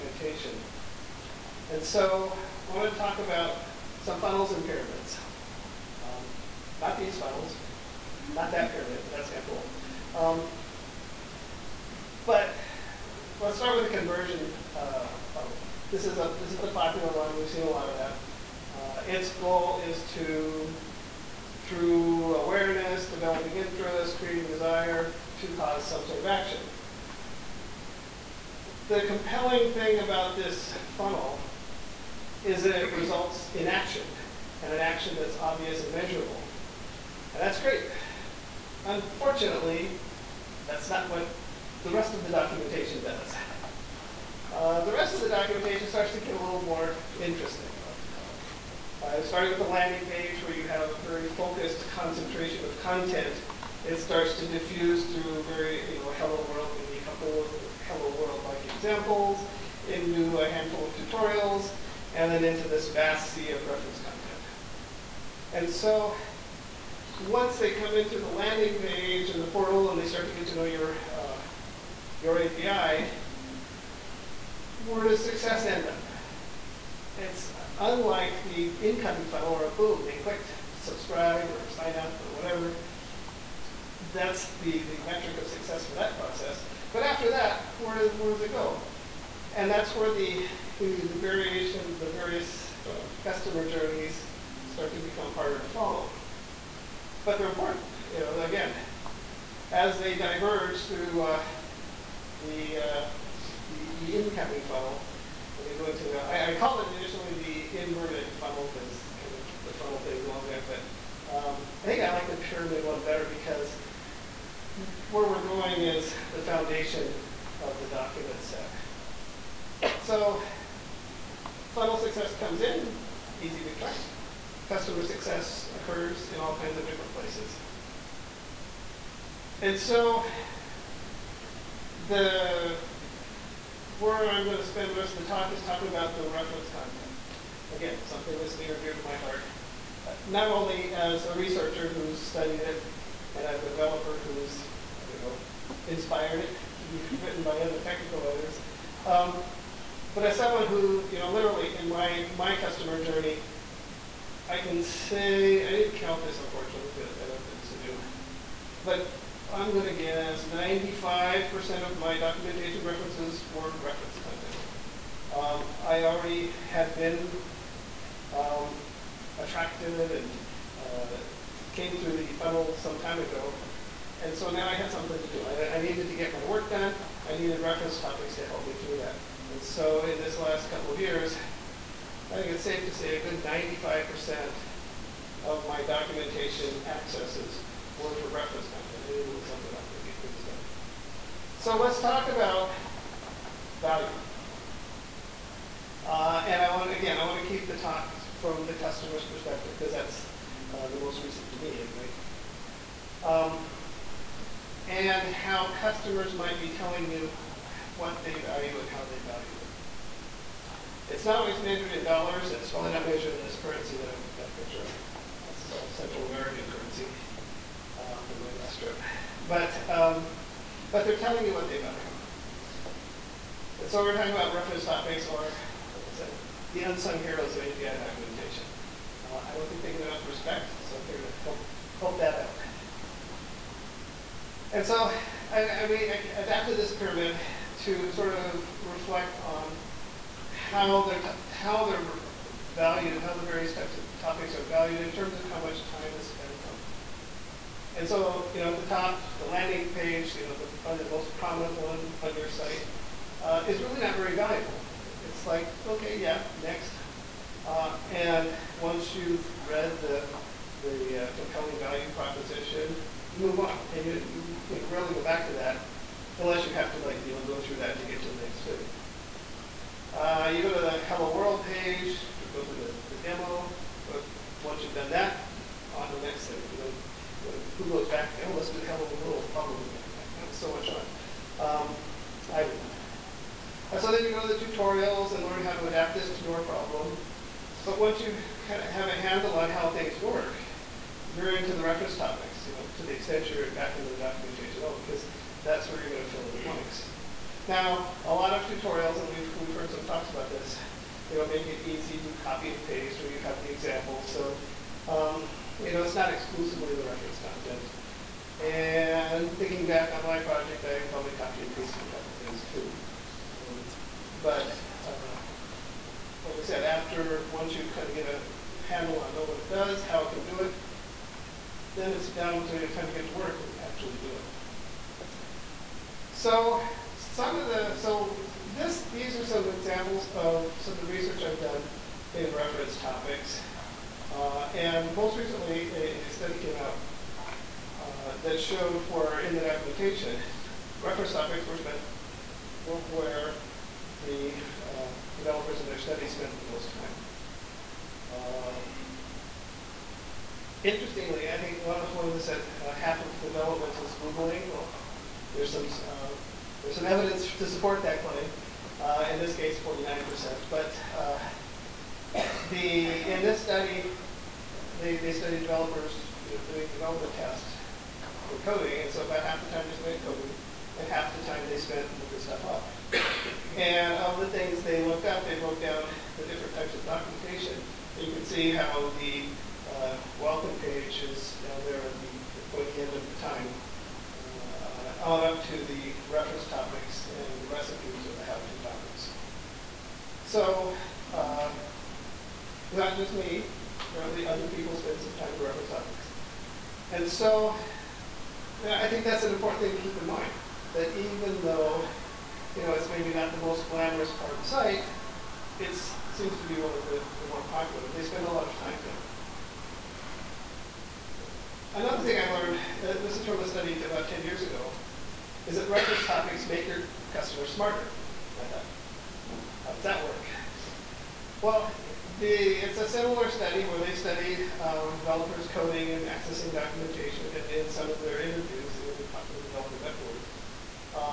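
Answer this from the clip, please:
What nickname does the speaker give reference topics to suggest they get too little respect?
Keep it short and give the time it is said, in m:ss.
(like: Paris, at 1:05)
the unsung heroes of API documentation, at 3:46.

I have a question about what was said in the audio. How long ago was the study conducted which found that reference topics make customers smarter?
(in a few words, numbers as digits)
about 10 years.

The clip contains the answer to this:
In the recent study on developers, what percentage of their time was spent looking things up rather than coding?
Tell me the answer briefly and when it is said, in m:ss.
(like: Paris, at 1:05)
49%, at 5:59.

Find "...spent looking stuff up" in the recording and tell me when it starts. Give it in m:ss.
6:11.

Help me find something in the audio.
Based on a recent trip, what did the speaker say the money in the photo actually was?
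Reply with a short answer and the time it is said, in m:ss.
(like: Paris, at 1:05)
Central American currency, at 3:35.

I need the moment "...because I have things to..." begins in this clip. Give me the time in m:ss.
2:36.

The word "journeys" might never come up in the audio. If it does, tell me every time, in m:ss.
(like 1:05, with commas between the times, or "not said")
1:33, 2:33.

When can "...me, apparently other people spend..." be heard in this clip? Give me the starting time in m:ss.
6:33.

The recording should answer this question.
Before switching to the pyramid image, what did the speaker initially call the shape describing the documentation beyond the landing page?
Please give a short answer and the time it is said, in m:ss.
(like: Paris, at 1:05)
the inverted funnel, at 1:47.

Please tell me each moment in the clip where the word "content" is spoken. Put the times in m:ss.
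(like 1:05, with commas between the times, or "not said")
0:52, 1:03, 2:16, 2:44, 3:08, 5:07.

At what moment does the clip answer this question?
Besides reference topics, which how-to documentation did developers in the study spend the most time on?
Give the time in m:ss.
6:27.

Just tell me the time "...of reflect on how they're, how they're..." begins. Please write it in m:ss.
3:58.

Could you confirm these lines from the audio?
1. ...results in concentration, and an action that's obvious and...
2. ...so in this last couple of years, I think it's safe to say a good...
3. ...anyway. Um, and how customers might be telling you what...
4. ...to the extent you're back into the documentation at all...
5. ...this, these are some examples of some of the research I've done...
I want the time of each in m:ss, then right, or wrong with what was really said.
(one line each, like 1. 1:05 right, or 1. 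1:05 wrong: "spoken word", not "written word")
1. 0:32 wrong: "action", not "concentration"
2. 2:59 right
3. 3:21 right
4. 4:52 right
5. 5:28 right.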